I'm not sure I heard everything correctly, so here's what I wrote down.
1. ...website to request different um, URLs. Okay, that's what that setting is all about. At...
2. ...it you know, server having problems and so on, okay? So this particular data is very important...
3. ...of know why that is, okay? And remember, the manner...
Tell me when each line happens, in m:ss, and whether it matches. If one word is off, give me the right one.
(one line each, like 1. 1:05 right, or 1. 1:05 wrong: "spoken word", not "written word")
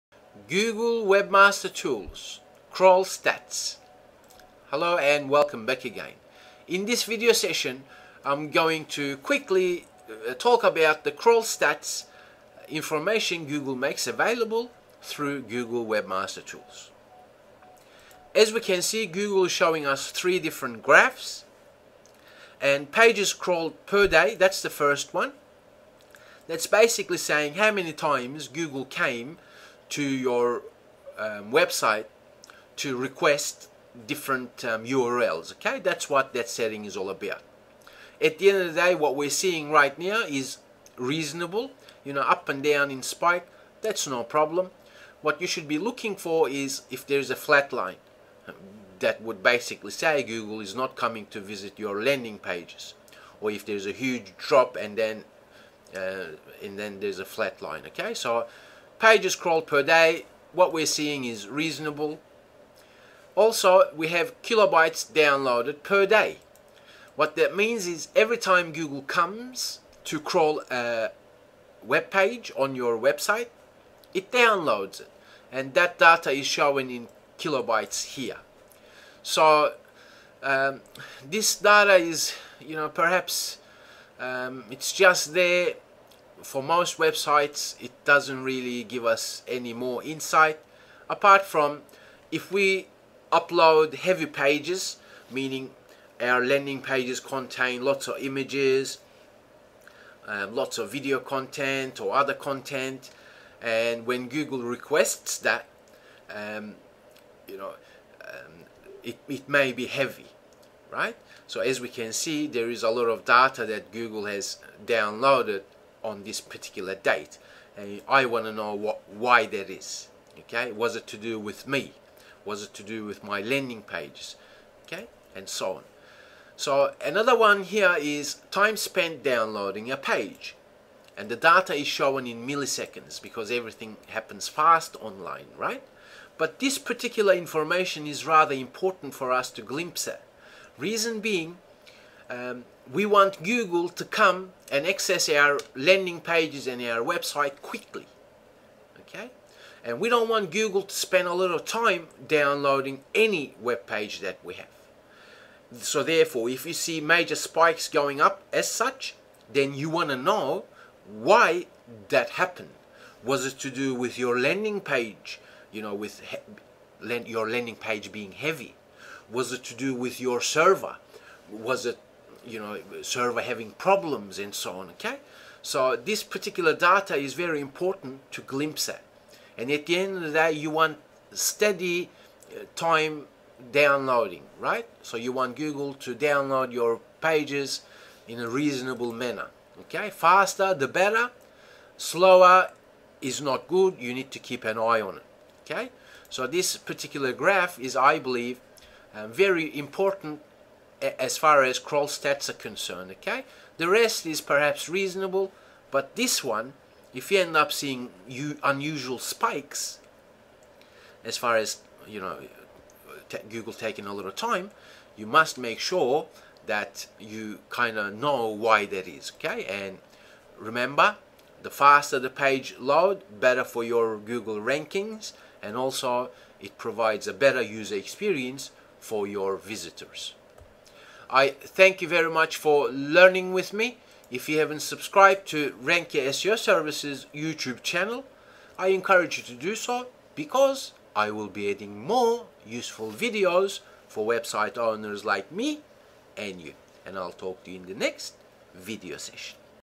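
1. 0:31 right
2. 2:51 right
3. 3:37 wrong: "faster", not "manner".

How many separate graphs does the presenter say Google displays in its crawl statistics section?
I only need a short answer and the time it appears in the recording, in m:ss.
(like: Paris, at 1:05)
3, at 0:20.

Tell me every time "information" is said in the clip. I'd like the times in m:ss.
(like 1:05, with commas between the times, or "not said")
0:12, 2:17.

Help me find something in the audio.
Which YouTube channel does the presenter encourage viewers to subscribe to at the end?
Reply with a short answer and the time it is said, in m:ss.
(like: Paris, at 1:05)
RankYa SEO Services, at 3:55.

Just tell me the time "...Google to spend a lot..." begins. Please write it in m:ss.
2:30.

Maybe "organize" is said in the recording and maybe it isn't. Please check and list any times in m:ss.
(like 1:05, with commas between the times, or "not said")
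not said.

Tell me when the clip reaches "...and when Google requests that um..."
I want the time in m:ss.
1:43.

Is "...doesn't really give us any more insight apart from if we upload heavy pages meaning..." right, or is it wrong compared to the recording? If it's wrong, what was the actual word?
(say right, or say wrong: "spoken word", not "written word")
right.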